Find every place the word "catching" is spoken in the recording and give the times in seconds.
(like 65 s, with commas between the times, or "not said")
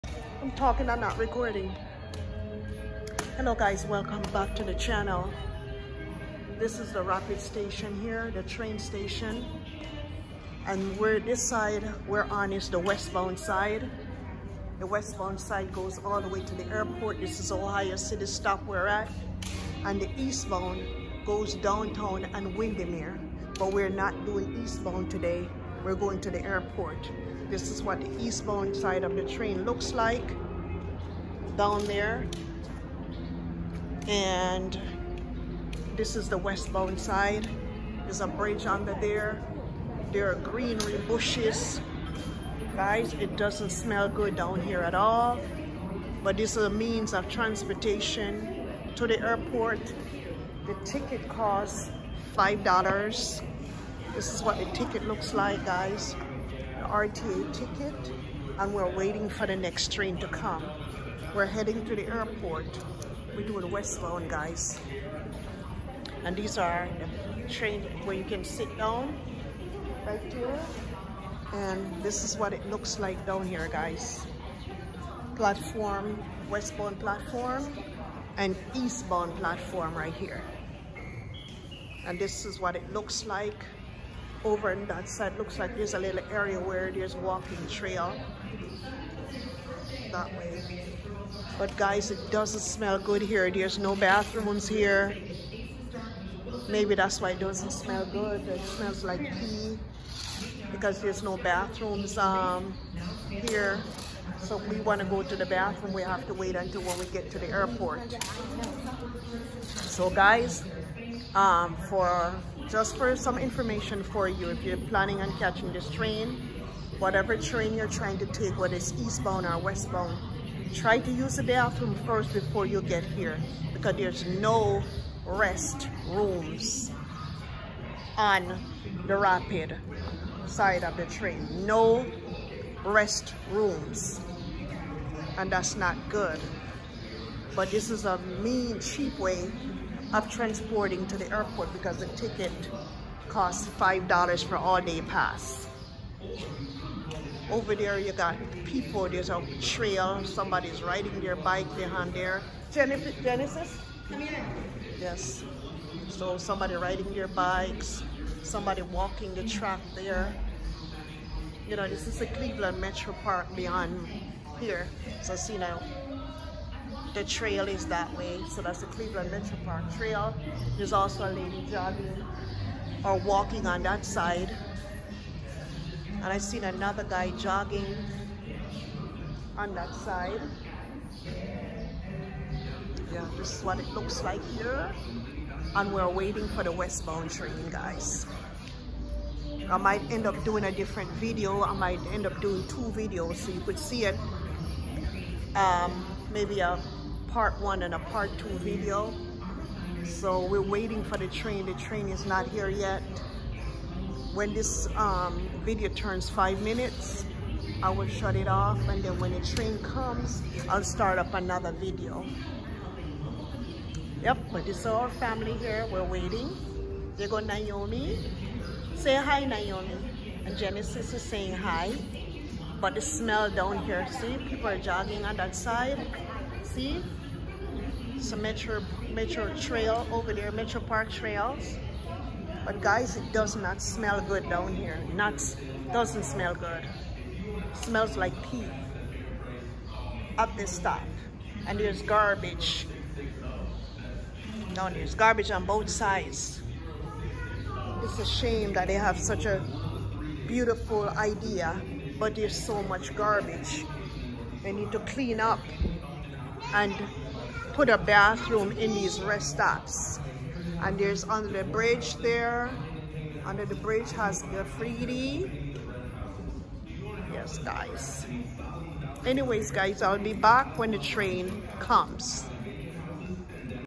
115 s.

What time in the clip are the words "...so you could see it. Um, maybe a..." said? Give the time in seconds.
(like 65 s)
193 s.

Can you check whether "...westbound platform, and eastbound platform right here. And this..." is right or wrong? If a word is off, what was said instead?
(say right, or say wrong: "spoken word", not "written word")
right.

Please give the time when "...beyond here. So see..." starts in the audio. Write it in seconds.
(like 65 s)
163 s.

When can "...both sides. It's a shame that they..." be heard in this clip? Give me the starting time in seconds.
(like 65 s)
245 s.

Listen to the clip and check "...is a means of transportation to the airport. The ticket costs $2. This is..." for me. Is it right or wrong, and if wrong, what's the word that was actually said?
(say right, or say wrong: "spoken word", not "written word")
wrong: "5", not "2".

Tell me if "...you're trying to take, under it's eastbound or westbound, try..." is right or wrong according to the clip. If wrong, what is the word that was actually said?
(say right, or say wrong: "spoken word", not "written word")
wrong: "whether", not "under".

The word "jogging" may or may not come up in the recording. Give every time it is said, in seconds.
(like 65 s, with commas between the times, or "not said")
171 s, 177 s, 224 s.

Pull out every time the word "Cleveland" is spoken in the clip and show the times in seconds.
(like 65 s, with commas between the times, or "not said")
162 s, 168 s.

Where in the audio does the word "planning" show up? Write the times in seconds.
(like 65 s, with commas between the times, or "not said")
114 s.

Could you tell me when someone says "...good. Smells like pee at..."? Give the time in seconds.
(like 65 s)
236 s.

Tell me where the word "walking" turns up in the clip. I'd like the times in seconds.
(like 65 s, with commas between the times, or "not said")
87 s, 158 s, 173 s.